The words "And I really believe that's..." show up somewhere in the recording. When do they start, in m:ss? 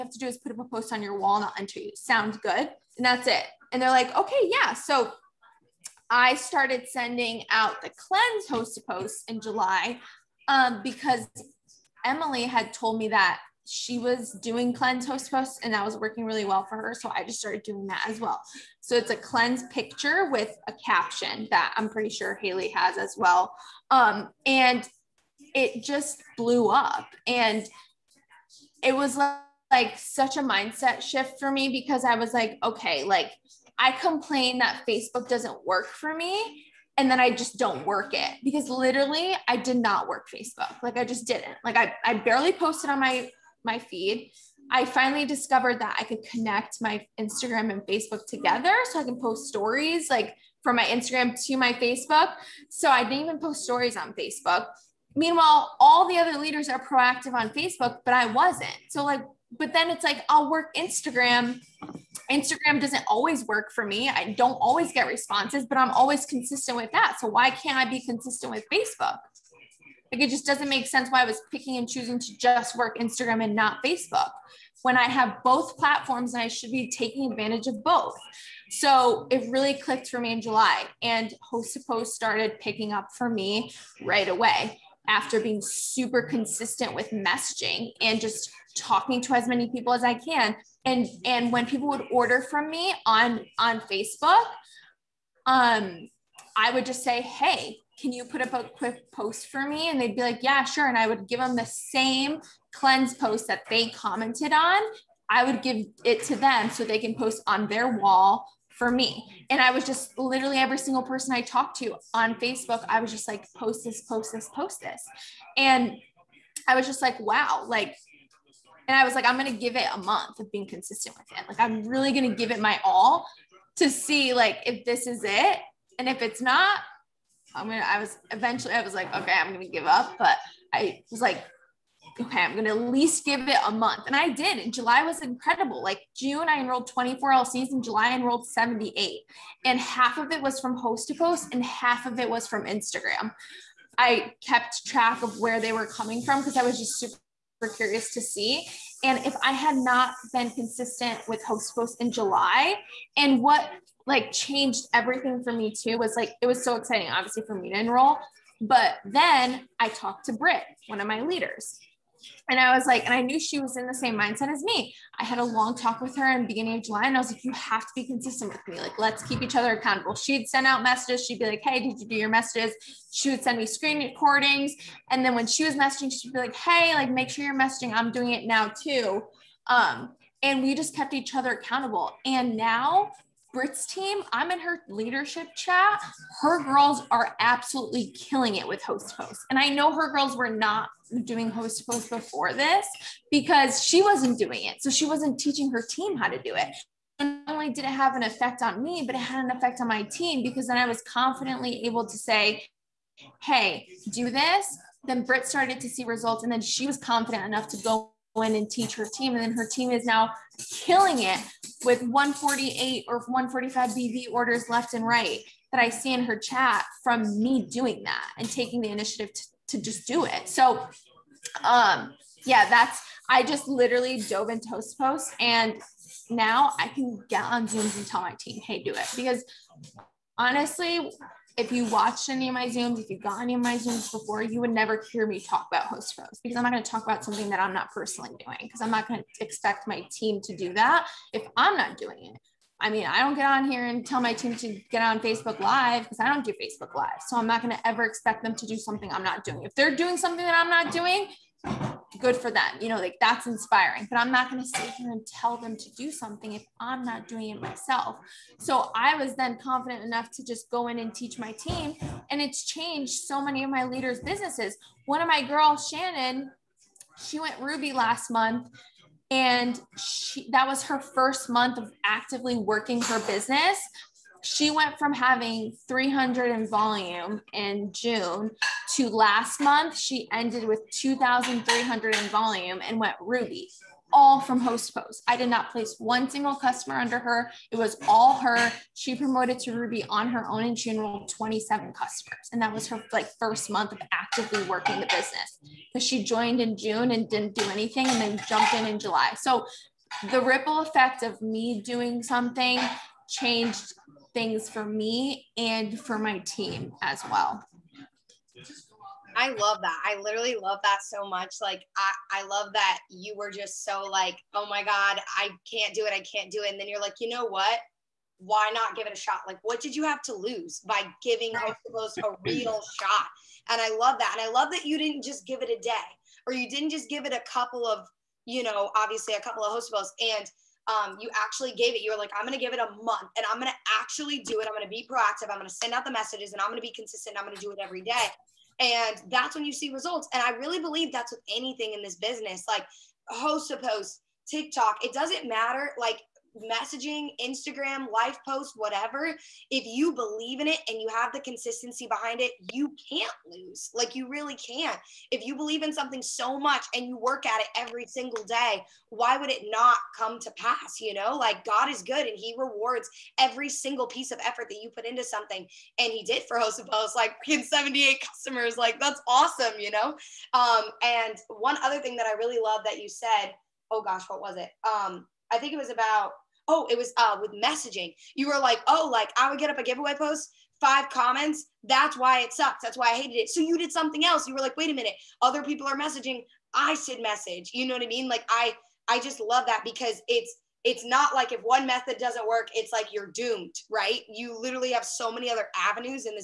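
5:40.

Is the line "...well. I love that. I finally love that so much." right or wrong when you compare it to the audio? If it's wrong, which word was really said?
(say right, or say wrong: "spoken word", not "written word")
wrong: "literally", not "finally".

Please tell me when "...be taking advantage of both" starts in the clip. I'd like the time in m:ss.
1:16.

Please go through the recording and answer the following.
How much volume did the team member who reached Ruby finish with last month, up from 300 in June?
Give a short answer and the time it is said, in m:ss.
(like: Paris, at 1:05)
2,300, at 4:40.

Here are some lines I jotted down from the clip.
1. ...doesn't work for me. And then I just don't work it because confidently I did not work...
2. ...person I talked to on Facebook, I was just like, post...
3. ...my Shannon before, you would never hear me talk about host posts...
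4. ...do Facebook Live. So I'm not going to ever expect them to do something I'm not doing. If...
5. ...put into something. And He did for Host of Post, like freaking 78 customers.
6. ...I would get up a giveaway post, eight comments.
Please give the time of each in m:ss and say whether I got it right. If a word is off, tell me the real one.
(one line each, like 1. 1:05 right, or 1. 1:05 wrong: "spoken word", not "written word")
1. 0:35 wrong: "literally", not "confidently"
2. 1:51 right
3. 3:53 wrong: "Zooms", not "Shannon"
4. 4:06 right
5. 6:04 right
6. 6:19 wrong: "five", not "eight".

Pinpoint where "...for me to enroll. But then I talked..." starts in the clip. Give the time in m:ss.
2:37.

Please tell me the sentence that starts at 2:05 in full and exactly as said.
And if it's not, I'm going to, I was eventually, I was like, okay, I'm going to give up.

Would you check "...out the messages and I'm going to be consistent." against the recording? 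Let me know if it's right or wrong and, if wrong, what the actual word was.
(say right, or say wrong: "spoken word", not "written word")
right.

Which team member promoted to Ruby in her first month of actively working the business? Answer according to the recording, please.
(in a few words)
Shannon.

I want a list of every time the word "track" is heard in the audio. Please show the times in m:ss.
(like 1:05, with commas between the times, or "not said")
2:24.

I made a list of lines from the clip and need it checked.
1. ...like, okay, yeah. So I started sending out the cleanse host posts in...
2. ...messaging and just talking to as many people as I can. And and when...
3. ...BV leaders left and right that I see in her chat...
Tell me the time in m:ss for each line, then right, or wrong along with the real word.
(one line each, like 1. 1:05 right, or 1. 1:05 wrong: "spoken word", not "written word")
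1. 0:03 right
2. 1:27 right
3. 3:33 wrong: "orders", not "leaders".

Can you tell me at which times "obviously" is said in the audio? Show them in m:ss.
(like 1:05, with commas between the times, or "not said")
2:37, 5:28.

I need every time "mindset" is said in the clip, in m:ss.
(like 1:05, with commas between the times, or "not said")
0:30, 2:44.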